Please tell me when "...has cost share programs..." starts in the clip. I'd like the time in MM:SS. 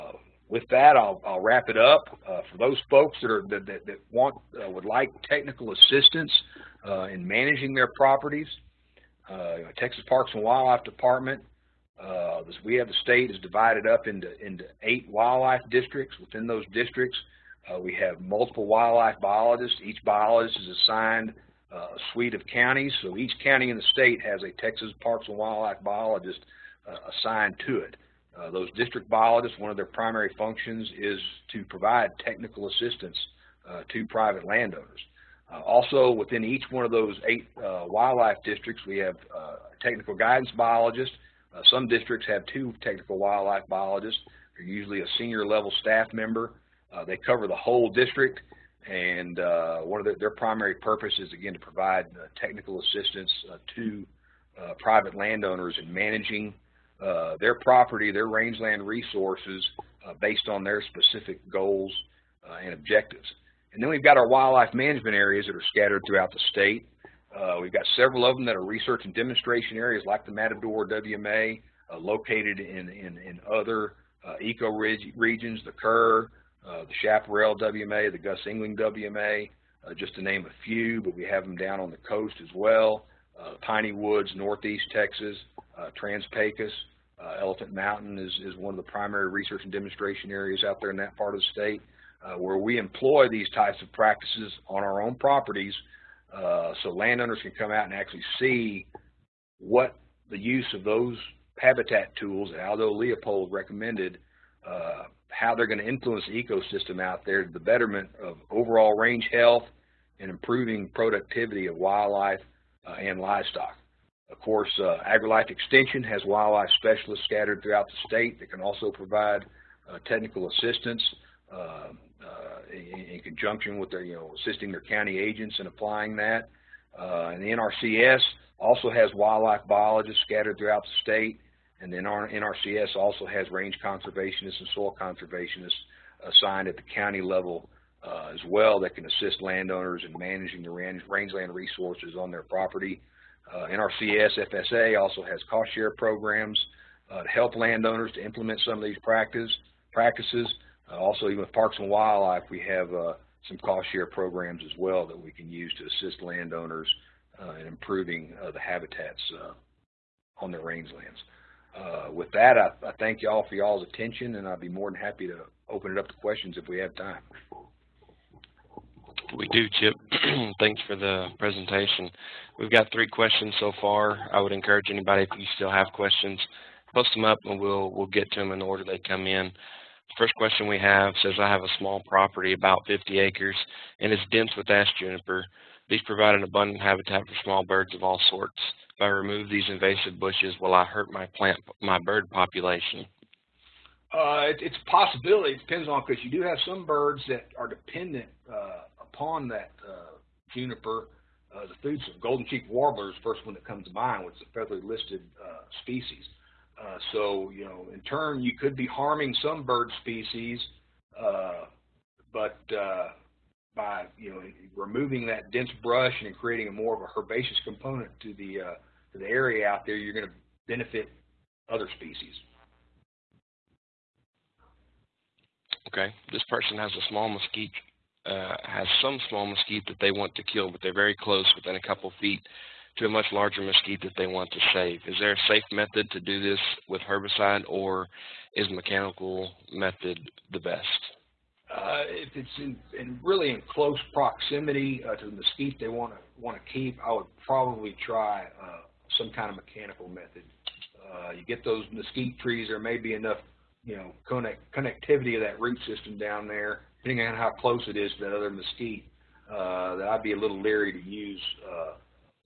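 02:25.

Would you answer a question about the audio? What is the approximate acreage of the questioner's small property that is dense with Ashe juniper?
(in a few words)
50 acres.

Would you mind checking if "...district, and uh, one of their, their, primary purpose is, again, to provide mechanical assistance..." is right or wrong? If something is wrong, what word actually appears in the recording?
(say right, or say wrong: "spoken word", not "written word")
wrong: "technical", not "mechanical".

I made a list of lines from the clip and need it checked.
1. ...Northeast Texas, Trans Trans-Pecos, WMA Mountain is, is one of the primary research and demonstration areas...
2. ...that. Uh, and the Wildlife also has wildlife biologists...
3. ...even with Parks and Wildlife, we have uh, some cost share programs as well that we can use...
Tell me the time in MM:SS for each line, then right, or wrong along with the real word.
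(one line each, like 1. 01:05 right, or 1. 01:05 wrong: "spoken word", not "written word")
1. 01:24 wrong: "Elephant", not "WMA"
2. 02:06 wrong: "NRCS", not "Wildlife"
3. 02:31 right.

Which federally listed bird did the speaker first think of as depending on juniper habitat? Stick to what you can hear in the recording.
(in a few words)
golden cheek warbler.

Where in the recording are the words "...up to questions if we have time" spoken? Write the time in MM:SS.
02:45.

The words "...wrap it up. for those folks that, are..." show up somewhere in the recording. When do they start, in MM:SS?
00:01.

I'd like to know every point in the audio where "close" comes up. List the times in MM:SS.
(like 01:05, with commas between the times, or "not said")
03:51, 04:03, 04:17.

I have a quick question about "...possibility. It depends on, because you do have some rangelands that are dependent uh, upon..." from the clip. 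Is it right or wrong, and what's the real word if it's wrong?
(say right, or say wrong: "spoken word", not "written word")
wrong: "birds", not "rangelands".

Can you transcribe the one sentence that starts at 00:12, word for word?
Uh, this, we have the state is divided up into, into eight wildlife districts.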